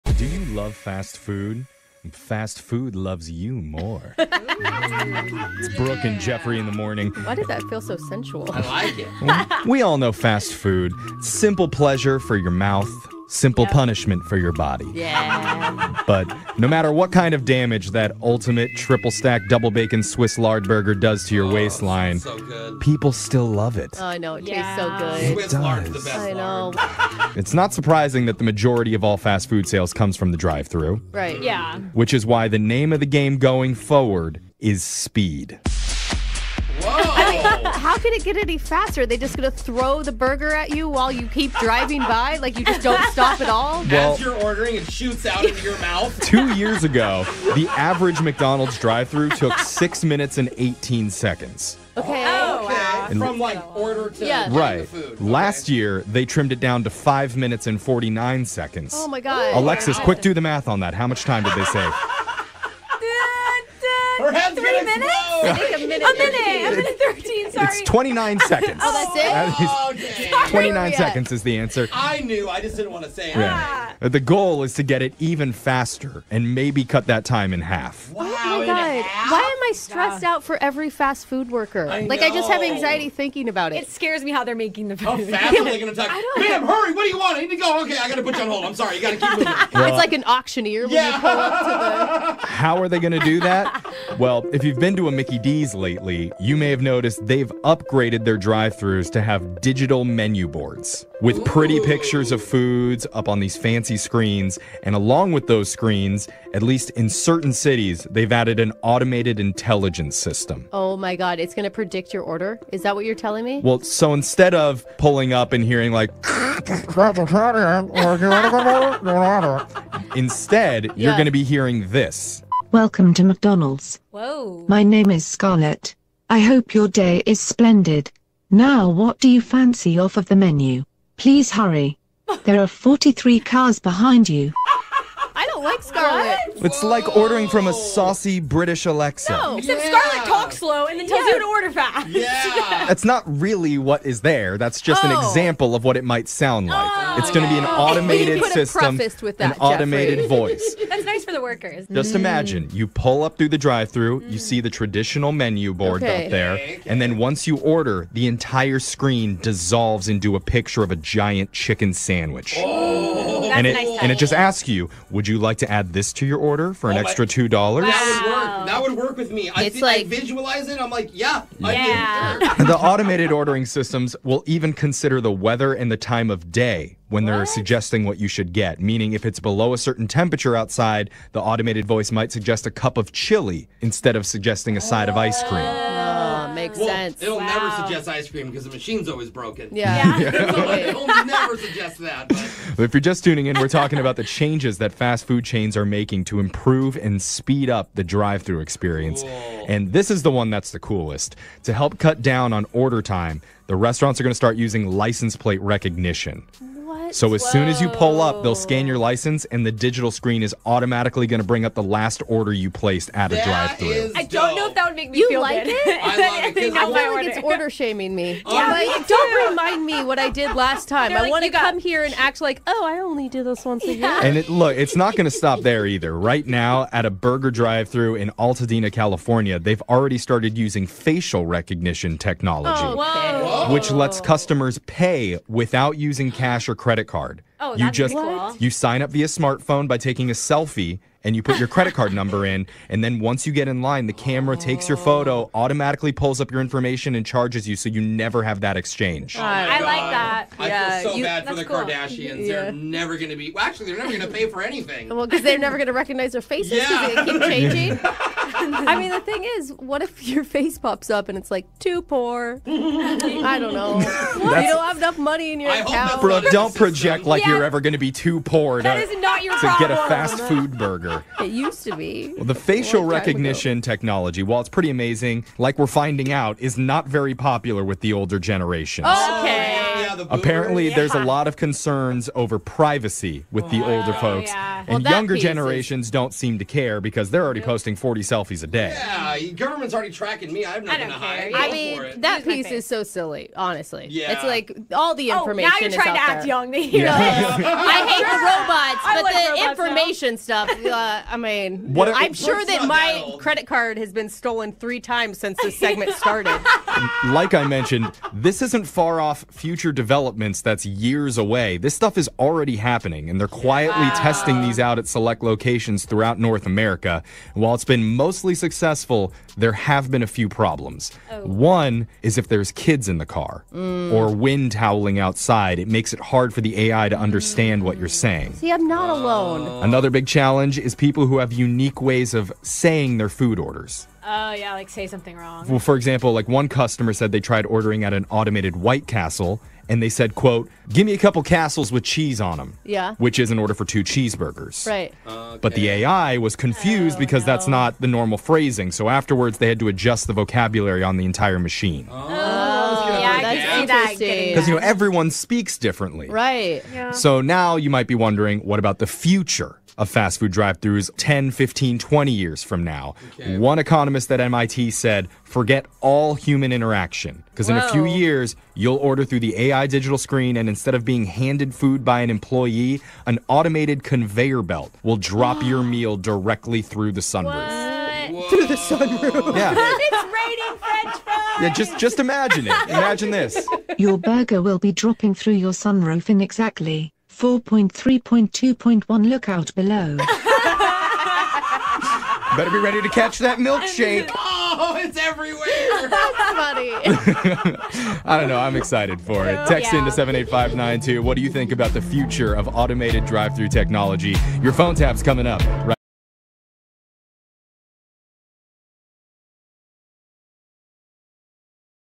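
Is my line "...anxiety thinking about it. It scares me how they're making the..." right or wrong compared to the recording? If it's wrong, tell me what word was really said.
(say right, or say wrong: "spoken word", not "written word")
right.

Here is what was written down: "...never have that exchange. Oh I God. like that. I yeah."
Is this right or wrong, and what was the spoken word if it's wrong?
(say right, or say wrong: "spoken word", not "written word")
right.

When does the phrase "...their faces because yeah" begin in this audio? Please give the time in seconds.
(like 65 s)
256 s.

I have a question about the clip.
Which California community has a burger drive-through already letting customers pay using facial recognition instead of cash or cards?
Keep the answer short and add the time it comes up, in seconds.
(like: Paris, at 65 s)
Altadena, at 228 s.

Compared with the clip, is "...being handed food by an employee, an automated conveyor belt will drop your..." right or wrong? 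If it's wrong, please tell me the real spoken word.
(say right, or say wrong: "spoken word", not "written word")
right.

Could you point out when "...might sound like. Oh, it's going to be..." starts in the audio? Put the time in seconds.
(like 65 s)
146 s.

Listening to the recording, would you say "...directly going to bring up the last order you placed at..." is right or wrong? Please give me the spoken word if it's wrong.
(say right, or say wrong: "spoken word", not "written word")
wrong: "automatically", not "directly".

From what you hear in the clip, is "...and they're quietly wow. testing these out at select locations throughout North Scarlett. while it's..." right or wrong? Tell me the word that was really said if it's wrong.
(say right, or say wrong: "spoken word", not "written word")
wrong: "America", not "Scarlett".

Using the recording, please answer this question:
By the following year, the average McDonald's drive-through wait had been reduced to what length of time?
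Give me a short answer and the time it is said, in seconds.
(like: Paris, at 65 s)
5 minutes and 49 seconds, at 56 s.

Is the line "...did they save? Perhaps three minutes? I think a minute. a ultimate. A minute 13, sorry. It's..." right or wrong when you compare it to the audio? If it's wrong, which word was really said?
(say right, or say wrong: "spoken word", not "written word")
wrong: "minute", not "ultimate".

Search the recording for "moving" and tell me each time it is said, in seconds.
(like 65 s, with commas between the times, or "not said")
89 s.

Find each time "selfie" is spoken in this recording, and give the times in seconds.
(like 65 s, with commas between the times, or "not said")
240 s, 288 s.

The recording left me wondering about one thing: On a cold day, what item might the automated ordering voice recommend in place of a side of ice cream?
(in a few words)
A cup of chili.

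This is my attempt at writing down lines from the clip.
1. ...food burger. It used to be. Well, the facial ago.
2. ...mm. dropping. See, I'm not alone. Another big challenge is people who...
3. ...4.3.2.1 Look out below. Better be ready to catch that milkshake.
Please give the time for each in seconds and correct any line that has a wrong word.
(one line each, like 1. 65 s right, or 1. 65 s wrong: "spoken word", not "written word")
1. 270 s right
2. 328 s wrong: "saying", not "dropping"
3. 387 s right.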